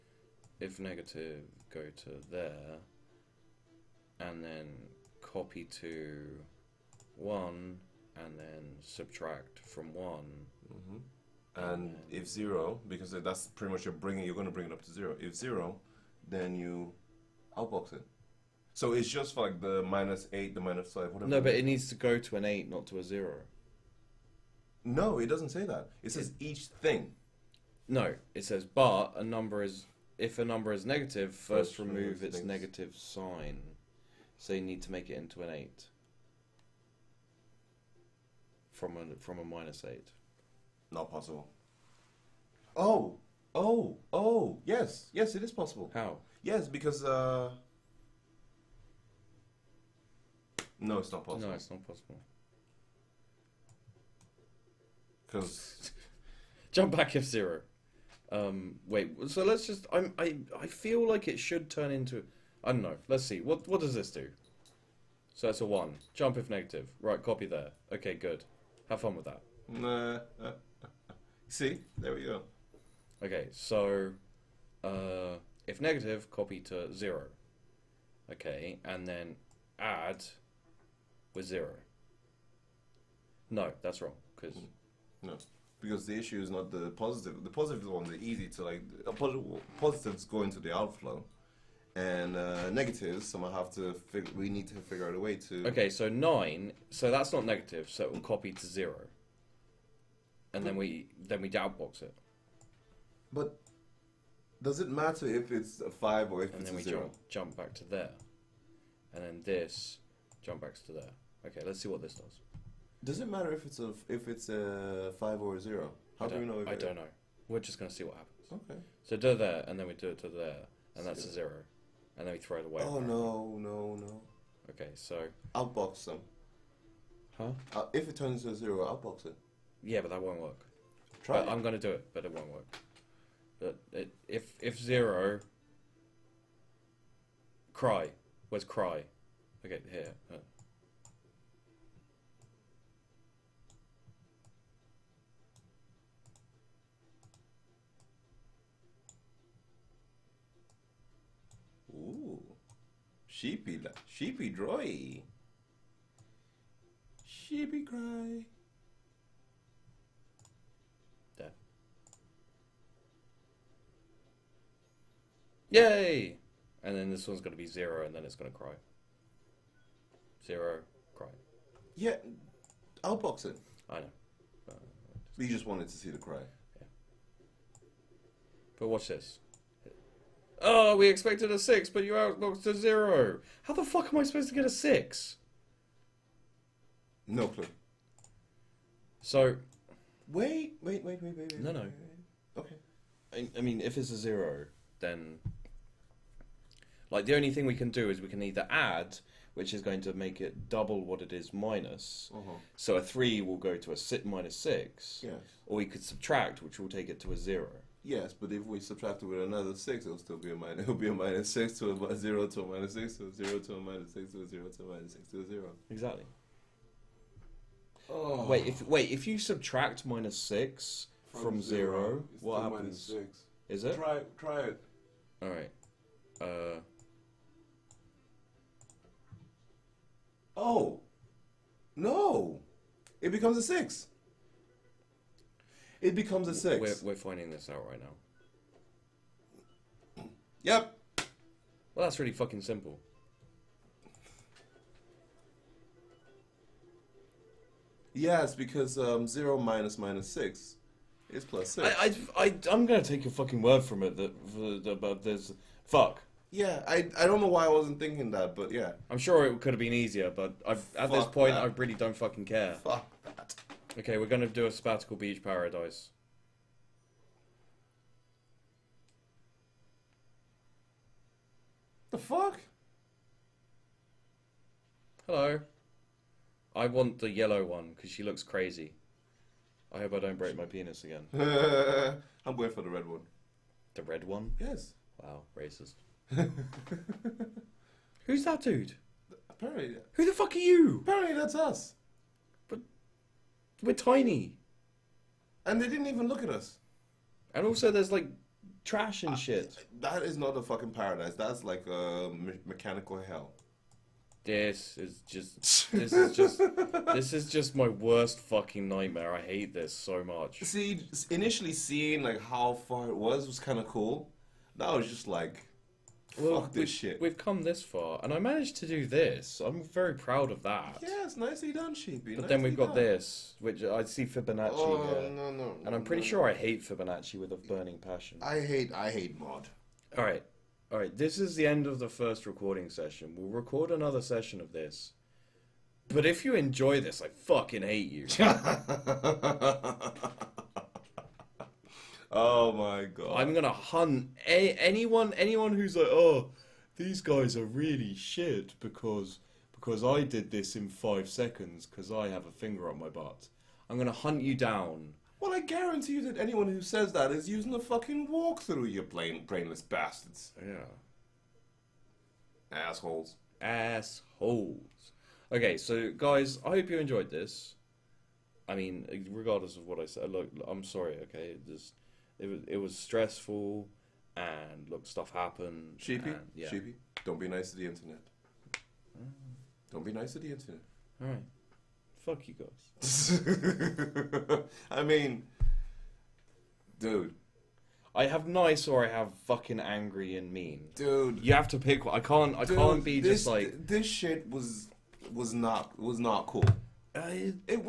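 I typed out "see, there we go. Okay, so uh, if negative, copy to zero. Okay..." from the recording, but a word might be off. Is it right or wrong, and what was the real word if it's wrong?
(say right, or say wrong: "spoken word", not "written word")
right.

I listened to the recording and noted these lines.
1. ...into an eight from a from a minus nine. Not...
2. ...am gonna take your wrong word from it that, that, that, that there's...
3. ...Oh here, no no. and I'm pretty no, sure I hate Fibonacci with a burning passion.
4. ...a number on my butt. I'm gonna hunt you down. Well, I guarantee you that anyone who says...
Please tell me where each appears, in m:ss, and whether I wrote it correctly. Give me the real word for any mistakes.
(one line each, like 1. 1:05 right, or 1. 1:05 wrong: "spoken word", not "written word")
1. 0:35 wrong: "eight", not "nine"
2. 4:12 wrong: "fucking", not "wrong"
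3. 5:24 right
4. 5:52 wrong: "finger", not "number".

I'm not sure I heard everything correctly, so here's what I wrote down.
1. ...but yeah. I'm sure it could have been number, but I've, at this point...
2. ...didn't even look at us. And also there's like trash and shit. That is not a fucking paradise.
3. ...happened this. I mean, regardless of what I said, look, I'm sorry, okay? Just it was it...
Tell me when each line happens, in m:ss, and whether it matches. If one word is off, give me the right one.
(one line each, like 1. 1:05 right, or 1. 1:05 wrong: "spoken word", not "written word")
1. 4:18 wrong: "easier", not "number"
2. 4:55 right
3. 6:06 wrong: "enjoyed", not "happened".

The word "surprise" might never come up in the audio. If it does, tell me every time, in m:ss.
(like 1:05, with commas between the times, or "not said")
not said.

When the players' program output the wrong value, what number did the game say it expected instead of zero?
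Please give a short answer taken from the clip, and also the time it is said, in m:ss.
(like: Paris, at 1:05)
6, at 3:00.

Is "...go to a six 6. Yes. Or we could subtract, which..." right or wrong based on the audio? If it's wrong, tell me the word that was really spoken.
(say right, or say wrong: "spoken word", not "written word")
right.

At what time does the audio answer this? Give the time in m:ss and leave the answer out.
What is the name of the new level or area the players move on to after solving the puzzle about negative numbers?
4:24.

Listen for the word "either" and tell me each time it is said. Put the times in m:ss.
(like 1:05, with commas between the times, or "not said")
3:18.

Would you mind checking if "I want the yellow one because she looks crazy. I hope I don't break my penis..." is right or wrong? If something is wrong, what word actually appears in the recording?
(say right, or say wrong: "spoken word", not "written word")
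right.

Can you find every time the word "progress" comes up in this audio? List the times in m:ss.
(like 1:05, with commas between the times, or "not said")
not said.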